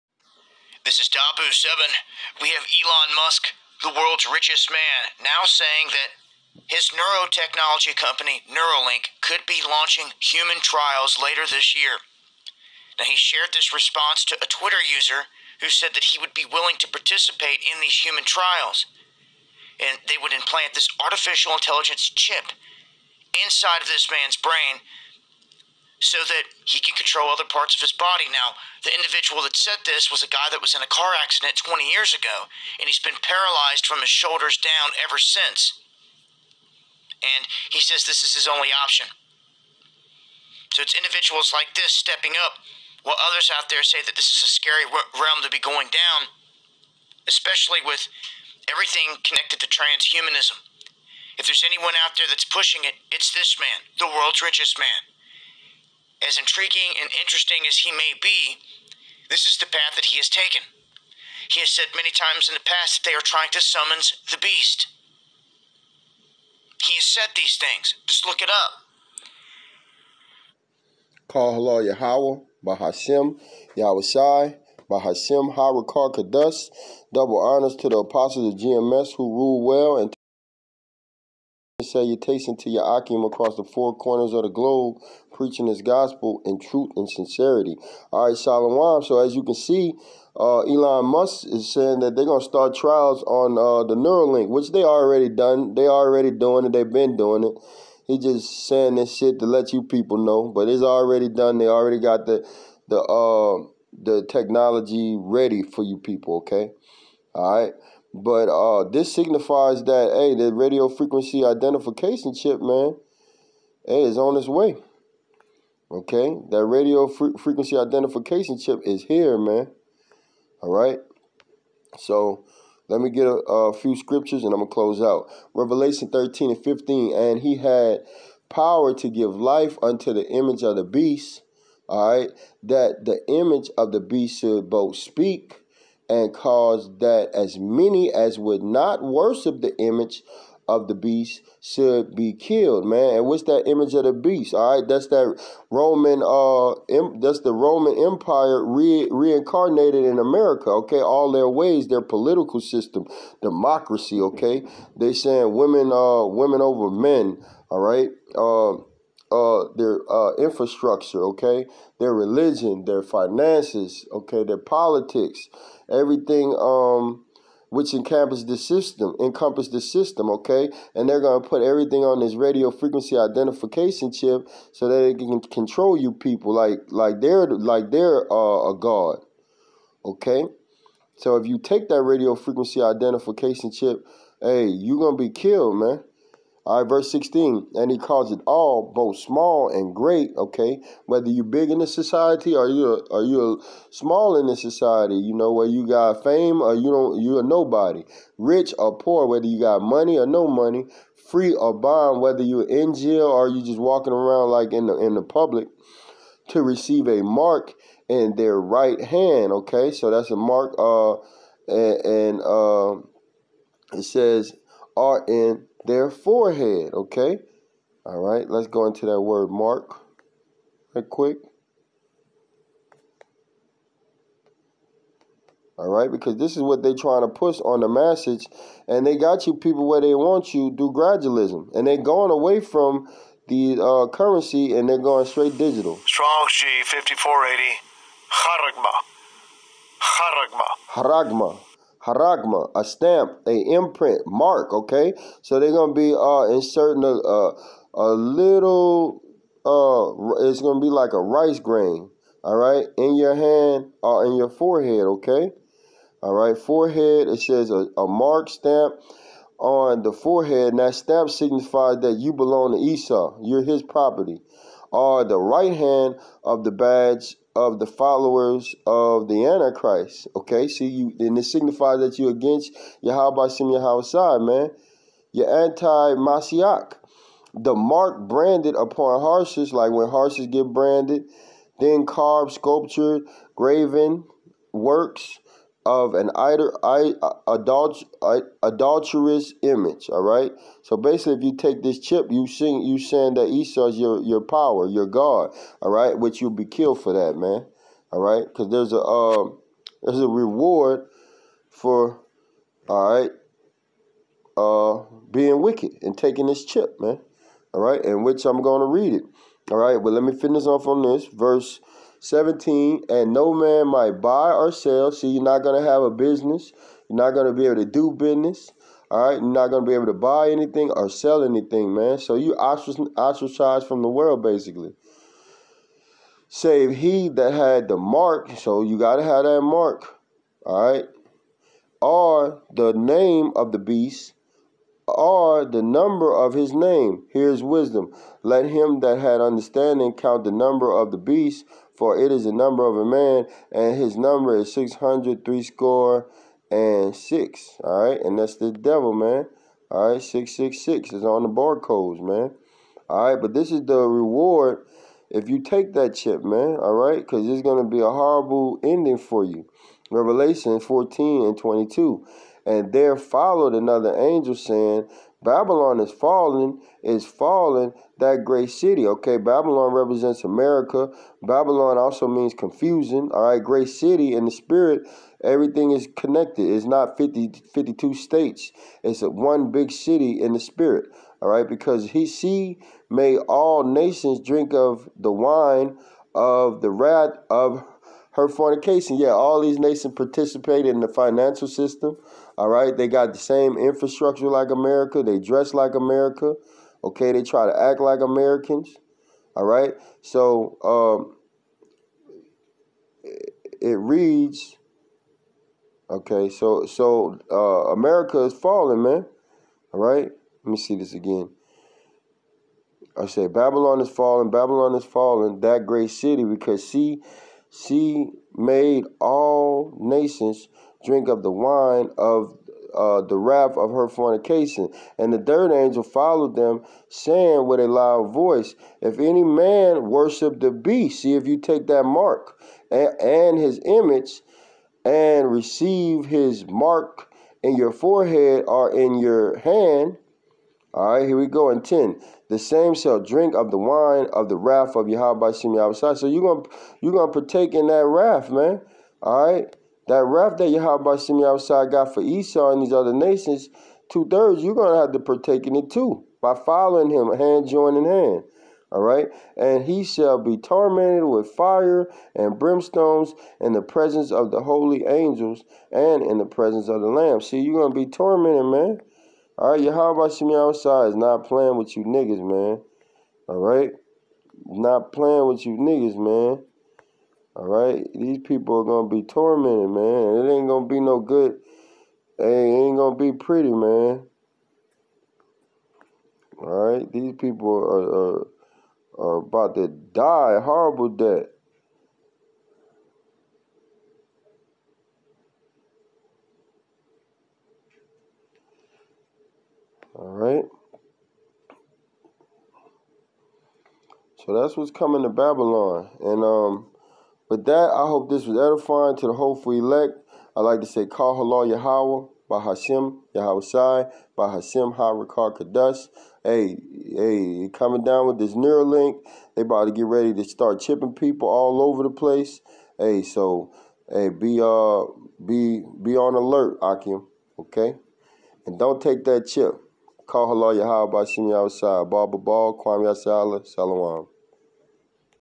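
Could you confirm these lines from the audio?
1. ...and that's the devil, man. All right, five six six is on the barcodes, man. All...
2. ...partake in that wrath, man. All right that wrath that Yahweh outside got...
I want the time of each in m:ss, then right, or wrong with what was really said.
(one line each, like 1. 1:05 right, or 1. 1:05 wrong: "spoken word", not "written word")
1. 5:48 wrong: "six", not "five"
2. 7:27 right.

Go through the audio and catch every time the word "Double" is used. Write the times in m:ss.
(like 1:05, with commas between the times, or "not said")
1:17.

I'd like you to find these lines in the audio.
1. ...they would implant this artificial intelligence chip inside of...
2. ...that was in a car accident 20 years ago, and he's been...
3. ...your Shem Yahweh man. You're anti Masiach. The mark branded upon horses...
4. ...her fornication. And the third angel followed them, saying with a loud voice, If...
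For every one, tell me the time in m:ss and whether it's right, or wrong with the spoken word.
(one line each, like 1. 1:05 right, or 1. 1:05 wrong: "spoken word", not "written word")
1. 0:20 right
2. 0:30 right
3. 4:33 right
4. 7:03 right.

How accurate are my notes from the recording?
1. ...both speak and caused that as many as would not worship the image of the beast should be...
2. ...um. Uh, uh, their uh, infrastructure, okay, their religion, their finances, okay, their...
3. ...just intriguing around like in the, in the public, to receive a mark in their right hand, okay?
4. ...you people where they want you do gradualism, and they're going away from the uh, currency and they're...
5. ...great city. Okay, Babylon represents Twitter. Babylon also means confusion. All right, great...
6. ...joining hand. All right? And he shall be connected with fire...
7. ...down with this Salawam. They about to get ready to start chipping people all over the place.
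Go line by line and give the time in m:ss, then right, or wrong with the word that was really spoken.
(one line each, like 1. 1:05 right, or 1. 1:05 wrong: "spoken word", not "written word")
1. 2:14 right
2. 2:38 right
3. 3:23 wrong: "walking", not "intriguing"
4. 3:49 right
5. 6:08 wrong: "America", not "Twitter"
6. 7:37 wrong: "tormented", not "connected"
7. 8:38 wrong: "Neuralink", not "Salawam".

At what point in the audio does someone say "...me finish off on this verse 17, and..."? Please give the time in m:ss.
5:10.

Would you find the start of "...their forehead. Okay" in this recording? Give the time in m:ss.
3:35.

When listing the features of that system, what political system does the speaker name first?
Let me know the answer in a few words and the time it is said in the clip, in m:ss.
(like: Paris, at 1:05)
Democracy, at 2:33.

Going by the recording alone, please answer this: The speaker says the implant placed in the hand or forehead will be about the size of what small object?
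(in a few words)
A rice grain.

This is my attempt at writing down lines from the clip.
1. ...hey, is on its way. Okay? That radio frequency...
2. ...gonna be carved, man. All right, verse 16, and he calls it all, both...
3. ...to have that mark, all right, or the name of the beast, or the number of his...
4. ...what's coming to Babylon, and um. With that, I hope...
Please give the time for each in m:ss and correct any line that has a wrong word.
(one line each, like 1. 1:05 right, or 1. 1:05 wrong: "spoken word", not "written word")
1. 1:53 right
2. 3:04 wrong: "killed", not "carved"
3. 5:29 right
4. 8:24 right.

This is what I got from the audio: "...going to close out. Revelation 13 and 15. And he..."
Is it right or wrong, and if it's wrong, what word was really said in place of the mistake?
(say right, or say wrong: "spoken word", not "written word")
right.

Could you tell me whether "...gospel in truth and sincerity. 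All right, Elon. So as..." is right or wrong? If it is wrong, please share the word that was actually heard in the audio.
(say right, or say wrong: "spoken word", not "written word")
wrong: "Shalom", not "Elon".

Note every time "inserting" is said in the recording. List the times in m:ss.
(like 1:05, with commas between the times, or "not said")
4:06.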